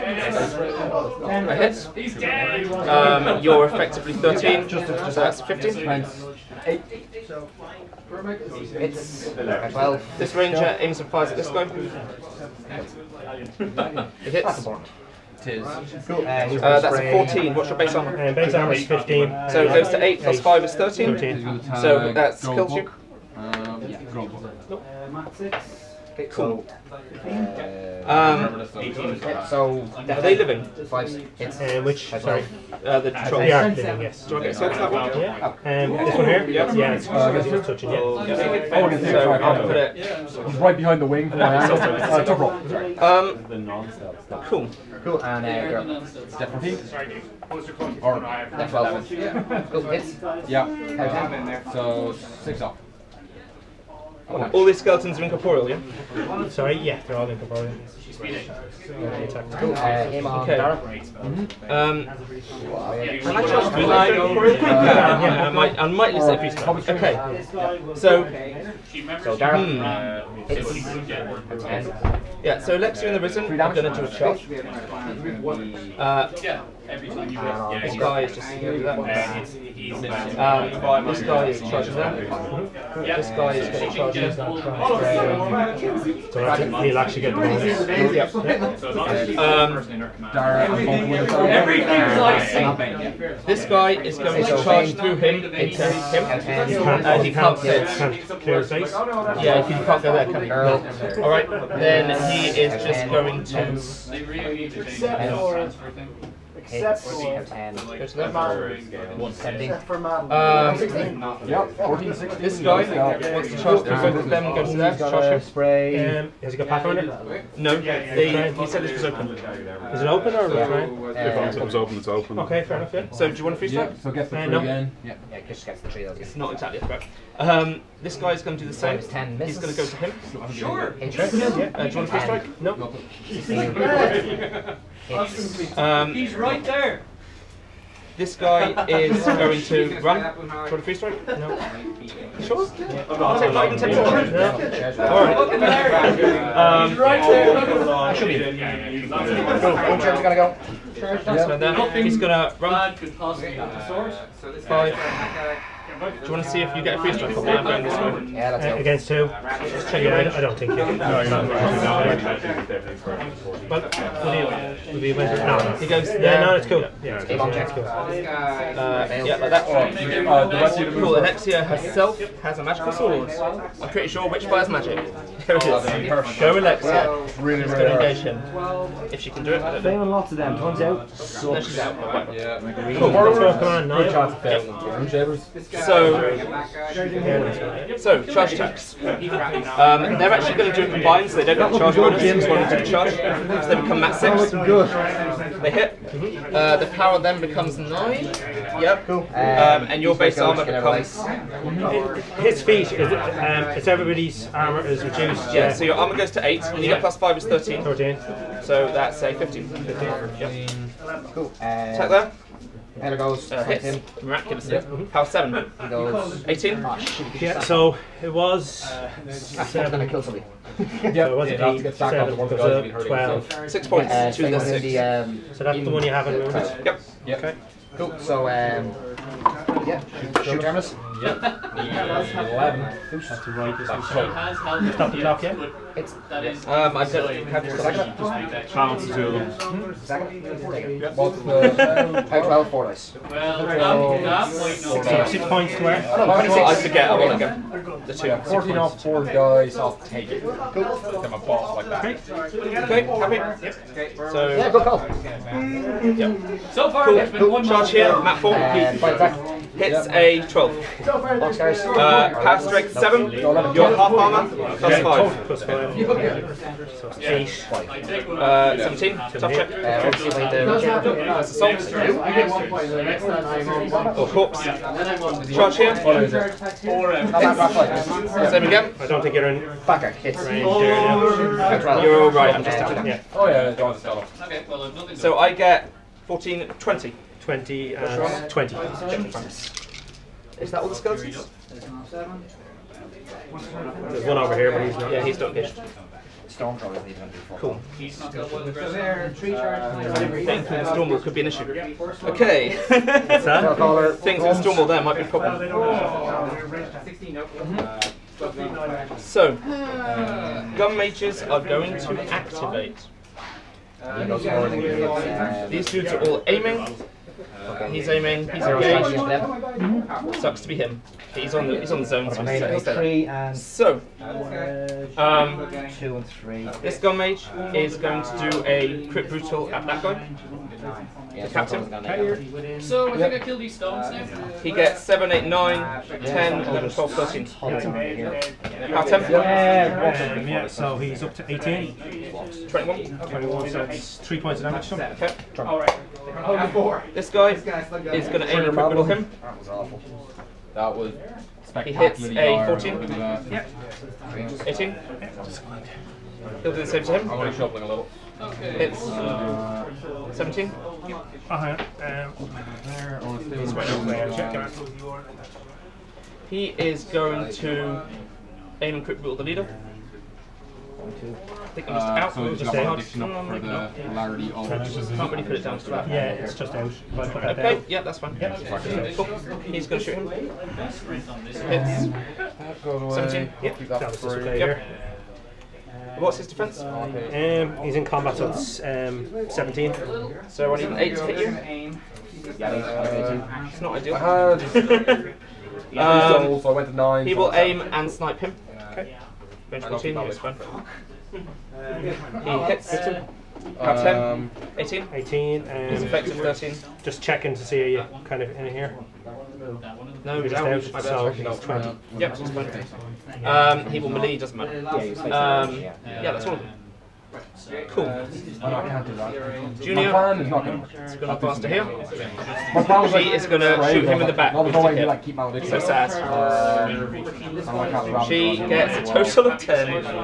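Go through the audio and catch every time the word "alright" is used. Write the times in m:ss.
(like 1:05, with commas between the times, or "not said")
2:23, 4:42.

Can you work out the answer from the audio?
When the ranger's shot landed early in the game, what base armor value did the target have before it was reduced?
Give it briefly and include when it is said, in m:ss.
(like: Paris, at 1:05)
15, at 0:18.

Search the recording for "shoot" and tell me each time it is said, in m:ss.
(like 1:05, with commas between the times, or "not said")
3:50, 6:20, 7:03.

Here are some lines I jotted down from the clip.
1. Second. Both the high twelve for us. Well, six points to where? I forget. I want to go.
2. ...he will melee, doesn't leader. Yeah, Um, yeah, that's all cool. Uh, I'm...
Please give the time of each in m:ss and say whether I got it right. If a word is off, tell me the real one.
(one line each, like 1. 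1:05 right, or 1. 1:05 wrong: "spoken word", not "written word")
1. 4:00 right
2. 6:53 wrong: "matter", not "leader".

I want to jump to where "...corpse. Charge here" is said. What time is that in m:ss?
4:34.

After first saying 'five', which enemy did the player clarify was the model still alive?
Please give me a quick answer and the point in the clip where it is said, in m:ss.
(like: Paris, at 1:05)
The troll, at 0:32.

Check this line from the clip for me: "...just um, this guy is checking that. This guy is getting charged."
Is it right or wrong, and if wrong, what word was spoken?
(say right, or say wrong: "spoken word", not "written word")
wrong: "charging", not "checking".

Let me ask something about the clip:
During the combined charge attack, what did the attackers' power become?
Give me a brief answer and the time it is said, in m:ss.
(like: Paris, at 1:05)
9, at 3:16.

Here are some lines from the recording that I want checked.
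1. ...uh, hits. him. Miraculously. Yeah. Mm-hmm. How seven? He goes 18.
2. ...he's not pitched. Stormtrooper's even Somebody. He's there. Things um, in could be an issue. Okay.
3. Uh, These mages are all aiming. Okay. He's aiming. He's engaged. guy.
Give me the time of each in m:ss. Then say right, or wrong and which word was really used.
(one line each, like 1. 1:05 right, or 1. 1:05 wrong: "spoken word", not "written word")
1. 3:33 right
2. 4:55 wrong: "Cool", not "Somebody"
3. 5:14 wrong: "dudes", not "mages".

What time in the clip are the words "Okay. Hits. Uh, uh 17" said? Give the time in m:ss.
5:58.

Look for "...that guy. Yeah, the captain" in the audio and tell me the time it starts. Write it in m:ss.
5:29.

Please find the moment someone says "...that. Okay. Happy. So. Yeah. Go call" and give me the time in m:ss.
4:12.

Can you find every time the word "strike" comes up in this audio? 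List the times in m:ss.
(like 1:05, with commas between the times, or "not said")
2:03, 2:12, 2:20, 2:37.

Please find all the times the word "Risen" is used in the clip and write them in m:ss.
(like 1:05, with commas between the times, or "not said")
1:13.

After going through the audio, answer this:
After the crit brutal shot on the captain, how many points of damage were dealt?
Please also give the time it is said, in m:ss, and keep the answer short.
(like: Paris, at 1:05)
3, at 5:44.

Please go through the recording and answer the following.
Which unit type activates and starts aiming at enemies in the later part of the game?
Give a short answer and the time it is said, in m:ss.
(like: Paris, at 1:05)
Gun mages, at 5:10.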